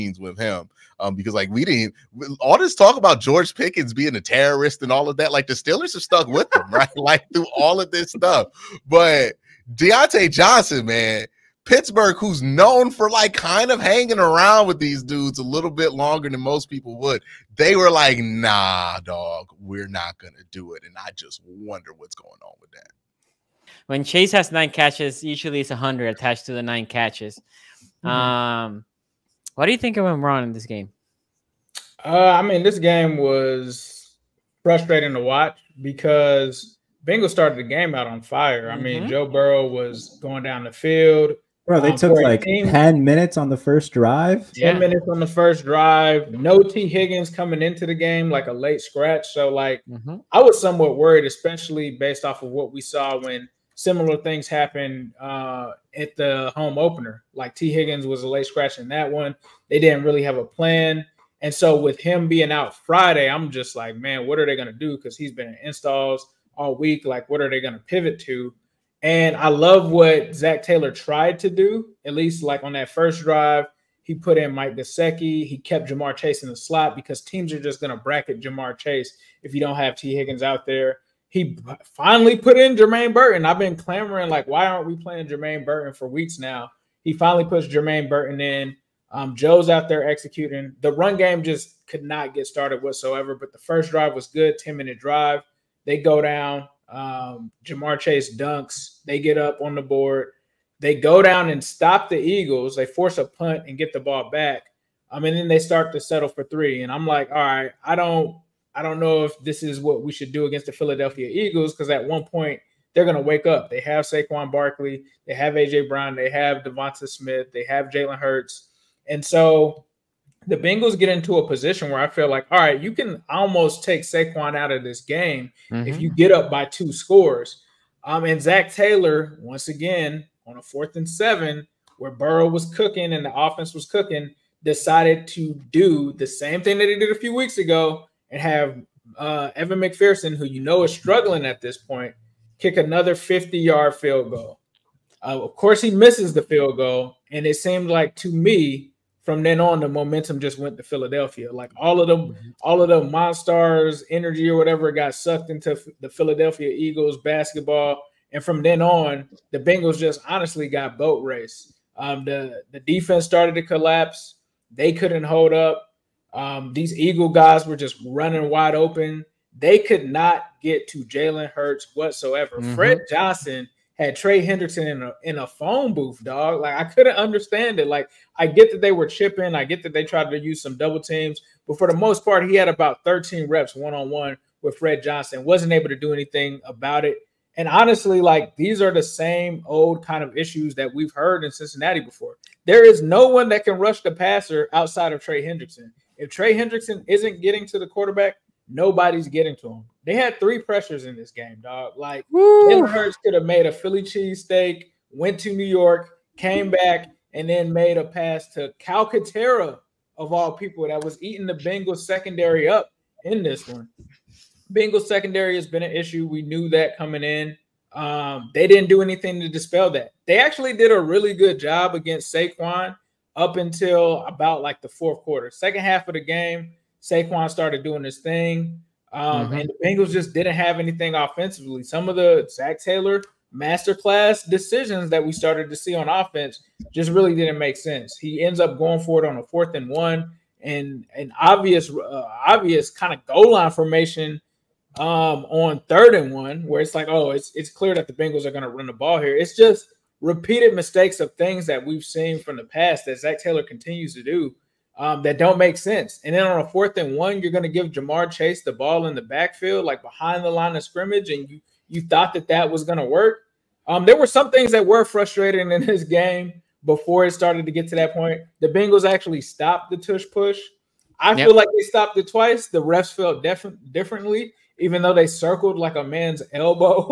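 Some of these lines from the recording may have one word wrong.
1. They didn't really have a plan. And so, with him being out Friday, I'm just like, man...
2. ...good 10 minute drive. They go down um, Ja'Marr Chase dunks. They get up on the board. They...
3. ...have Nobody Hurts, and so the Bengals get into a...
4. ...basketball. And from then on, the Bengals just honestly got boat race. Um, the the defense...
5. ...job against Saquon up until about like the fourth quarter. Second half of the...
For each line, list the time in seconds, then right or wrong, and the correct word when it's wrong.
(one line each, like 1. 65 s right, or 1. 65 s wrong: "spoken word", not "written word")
1. 59 s right
2. 94 s right
3. 117 s wrong: "Jalen", not "Nobody"
4. 157 s right
5. 221 s right.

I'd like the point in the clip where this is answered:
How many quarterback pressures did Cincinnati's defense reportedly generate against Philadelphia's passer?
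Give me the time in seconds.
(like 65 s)
200 s.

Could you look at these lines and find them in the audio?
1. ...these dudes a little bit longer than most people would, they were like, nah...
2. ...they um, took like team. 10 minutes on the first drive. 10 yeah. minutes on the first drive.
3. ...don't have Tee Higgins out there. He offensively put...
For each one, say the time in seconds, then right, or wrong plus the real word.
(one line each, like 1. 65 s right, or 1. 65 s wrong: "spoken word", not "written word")
1. 14 s right
2. 41 s right
3. 79 s wrong: "finally", not "offensively".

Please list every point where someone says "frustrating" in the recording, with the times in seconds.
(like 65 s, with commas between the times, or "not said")
34 s, 265 s.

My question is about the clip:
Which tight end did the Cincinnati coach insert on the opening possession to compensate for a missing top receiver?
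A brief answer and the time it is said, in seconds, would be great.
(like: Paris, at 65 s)
Mike Gesicki, at 74 s.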